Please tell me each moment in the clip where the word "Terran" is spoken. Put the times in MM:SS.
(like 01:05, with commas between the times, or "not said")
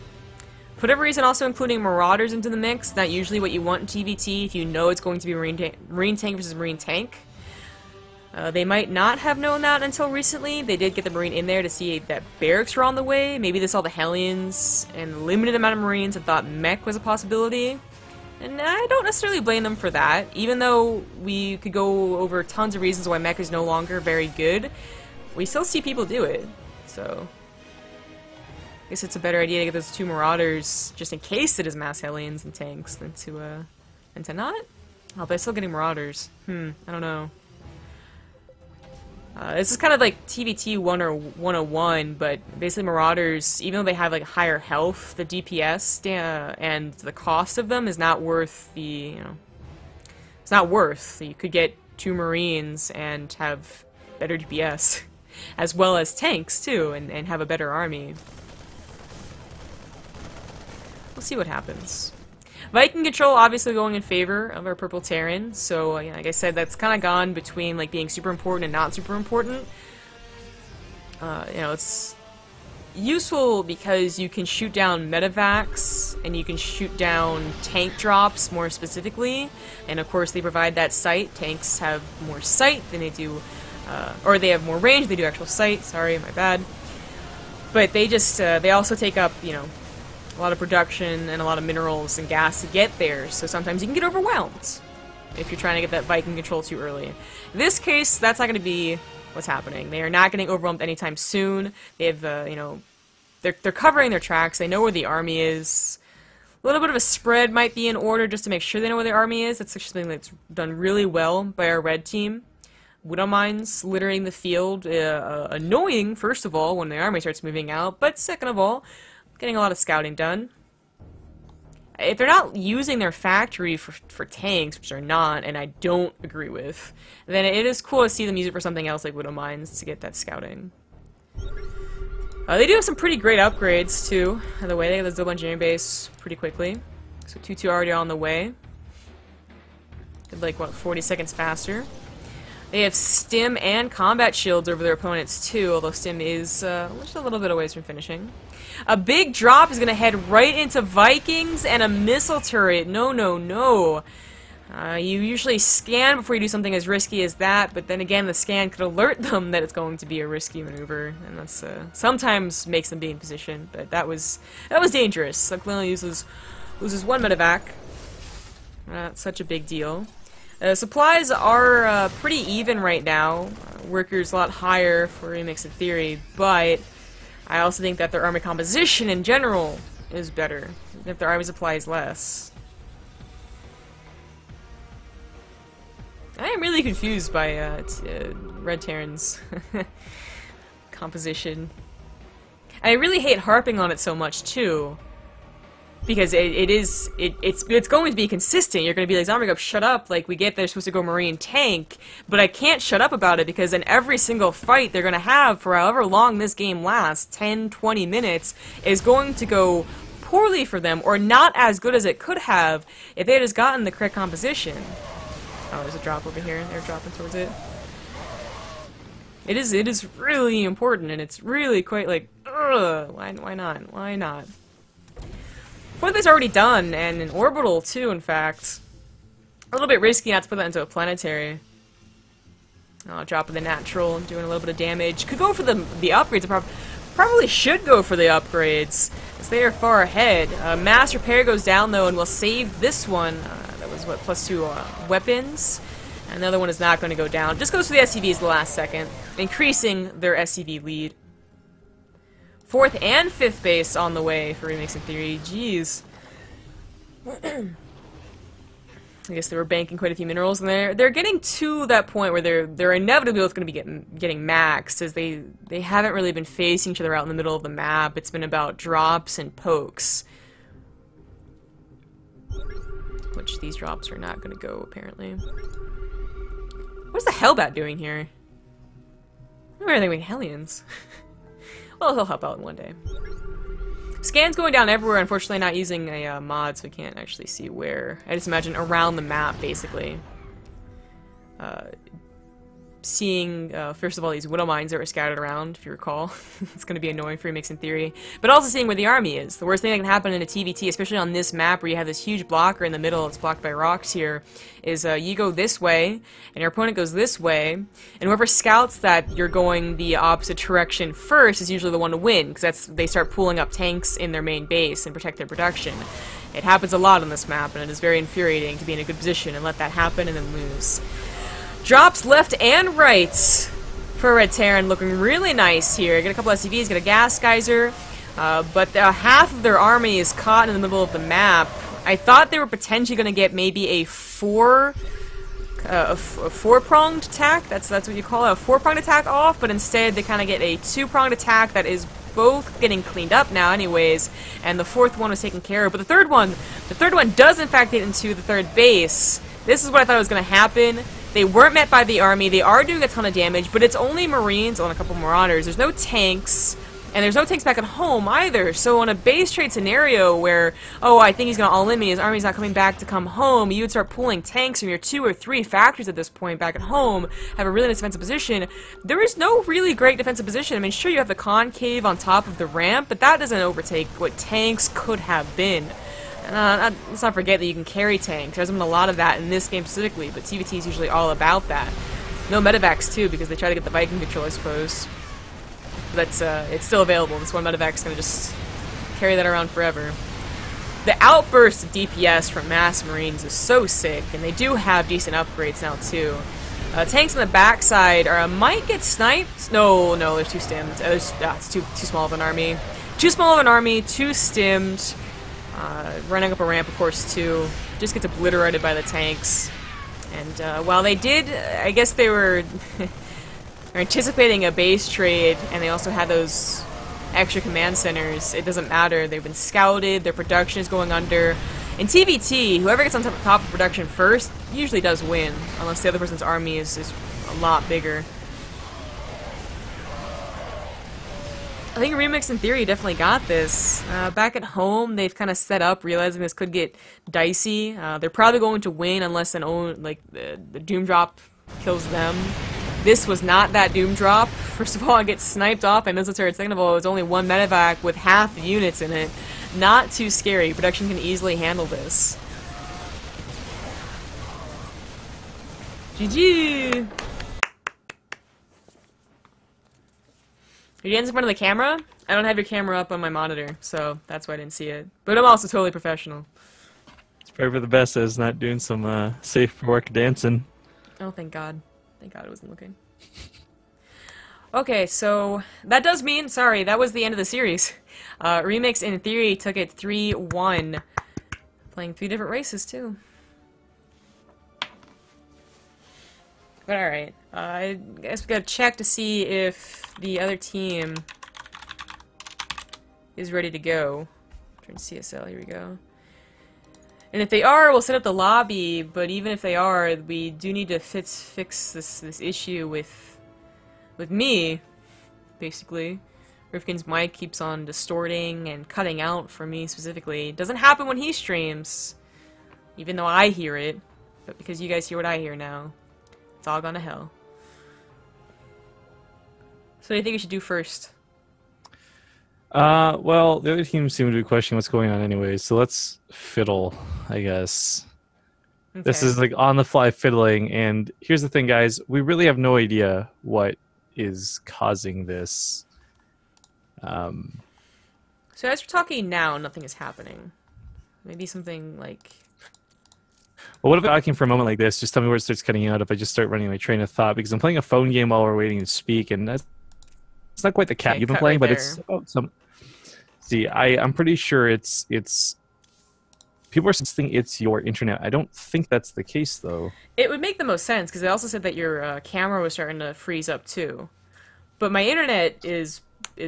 01:05, 03:08, 05:24.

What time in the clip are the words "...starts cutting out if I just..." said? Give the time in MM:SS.
09:05.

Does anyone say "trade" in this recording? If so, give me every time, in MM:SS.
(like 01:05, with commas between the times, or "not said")
05:59, 06:55.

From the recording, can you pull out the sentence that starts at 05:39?
But instead, they kind of get a two-pronged attack that is both getting cleaned up now, anyways.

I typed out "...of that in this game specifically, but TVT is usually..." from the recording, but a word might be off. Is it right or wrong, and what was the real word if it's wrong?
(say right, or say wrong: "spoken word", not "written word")
right.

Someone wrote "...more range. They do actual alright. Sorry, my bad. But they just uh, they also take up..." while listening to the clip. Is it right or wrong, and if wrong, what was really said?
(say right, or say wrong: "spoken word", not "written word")
wrong: "sight", not "alright".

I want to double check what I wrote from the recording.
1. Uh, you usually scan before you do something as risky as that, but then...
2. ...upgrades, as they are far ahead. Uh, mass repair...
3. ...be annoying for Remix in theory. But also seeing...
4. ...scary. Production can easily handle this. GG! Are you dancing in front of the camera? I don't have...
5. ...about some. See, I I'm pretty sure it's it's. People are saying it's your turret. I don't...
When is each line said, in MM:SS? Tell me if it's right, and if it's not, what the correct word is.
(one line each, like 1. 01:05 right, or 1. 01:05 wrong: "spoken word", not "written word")
1. 02:34 right
2. 03:58 right
3. 04:56 right
4. 07:30 right
5. 09:12 wrong: "internet", not "turret".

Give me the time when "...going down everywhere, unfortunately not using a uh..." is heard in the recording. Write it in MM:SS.
04:44.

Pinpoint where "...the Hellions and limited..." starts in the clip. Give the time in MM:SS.
00:13.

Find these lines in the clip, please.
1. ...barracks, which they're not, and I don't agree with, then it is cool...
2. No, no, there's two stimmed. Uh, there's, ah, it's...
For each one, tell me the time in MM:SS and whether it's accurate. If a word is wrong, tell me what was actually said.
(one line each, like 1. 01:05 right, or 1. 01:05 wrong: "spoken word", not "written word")
1. 02:04 wrong: "tanks", not "barracks"
2. 06:39 right.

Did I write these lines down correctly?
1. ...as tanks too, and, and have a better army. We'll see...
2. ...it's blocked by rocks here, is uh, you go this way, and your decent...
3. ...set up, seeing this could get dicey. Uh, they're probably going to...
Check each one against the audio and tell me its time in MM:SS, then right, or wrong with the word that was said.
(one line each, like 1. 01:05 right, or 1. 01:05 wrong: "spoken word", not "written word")
1. 00:55 right
2. 05:03 wrong: "opponent", not "decent"
3. 07:15 wrong: "realizing", not "seeing".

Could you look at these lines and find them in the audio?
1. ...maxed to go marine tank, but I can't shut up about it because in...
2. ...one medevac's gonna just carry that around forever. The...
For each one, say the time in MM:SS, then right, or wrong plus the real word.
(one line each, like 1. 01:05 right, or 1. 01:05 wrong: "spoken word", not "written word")
1. 03:20 wrong: "supposed", not "maxed"
2. 06:27 right.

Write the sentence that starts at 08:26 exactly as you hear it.
Rifkin's mic keeps on distorting and cutting out for me specifically.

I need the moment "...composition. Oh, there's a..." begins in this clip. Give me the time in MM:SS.
03:34.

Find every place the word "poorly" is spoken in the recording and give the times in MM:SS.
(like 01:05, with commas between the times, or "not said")
03:30.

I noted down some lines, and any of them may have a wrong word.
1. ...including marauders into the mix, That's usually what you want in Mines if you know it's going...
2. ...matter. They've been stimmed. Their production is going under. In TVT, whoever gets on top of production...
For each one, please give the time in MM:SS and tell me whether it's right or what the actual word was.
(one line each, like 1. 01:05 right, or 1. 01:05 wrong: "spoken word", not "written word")
1. 00:01 wrong: "TVT", not "Mines"
2. 06:58 wrong: "scouted", not "stimmed".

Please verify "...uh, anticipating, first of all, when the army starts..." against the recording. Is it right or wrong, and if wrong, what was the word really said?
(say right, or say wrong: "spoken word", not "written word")
wrong: "annoying", not "anticipating".